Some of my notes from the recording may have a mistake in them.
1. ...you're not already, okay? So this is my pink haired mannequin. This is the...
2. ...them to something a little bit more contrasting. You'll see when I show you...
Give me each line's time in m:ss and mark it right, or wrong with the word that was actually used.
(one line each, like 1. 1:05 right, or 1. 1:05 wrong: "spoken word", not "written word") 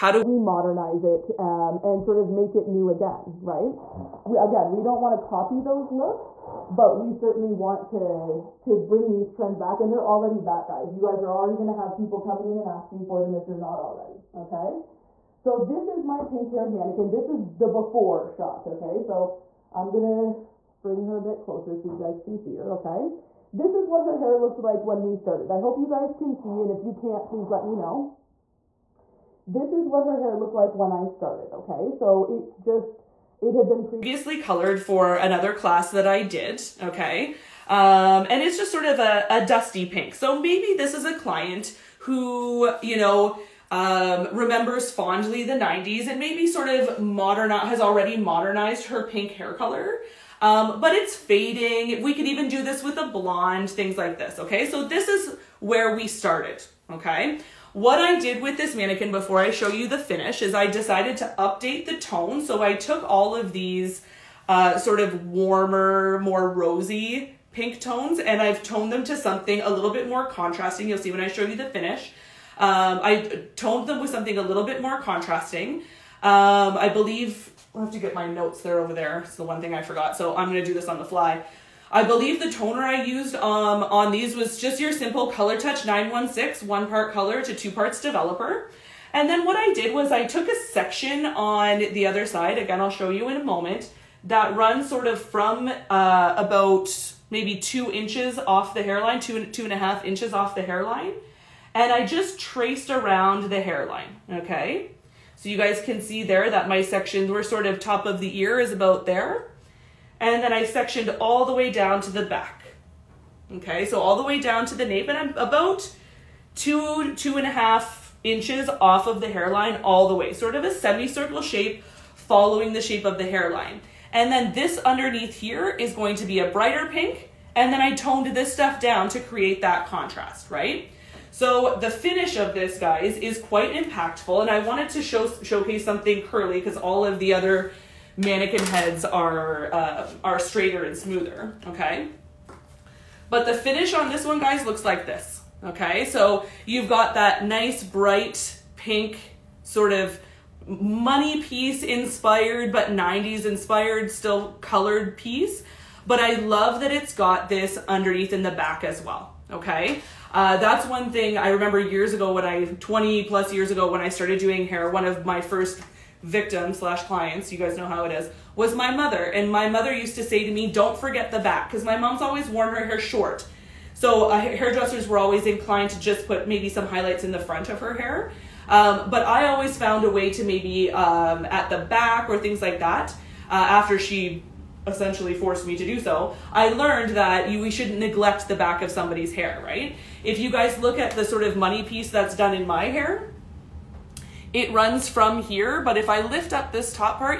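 1. 0:13 right
2. 1:08 right.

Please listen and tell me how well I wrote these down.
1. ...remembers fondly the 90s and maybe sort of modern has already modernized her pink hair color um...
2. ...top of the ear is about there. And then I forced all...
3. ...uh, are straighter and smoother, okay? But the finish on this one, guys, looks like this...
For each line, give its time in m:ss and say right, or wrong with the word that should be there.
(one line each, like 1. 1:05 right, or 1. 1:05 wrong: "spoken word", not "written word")
1. 0:44 right
2. 1:47 wrong: "sectioned", not "forced"
3. 2:19 right.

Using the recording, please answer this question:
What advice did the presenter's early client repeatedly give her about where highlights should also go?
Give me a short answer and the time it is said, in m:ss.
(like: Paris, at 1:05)
don't forget the back, at 2:50.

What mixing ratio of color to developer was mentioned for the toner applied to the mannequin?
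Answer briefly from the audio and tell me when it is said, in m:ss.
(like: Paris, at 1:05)
1 part color to 2 parts developer, at 1:26.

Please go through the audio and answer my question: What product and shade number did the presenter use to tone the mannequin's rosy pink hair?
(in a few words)
Color Touch 916.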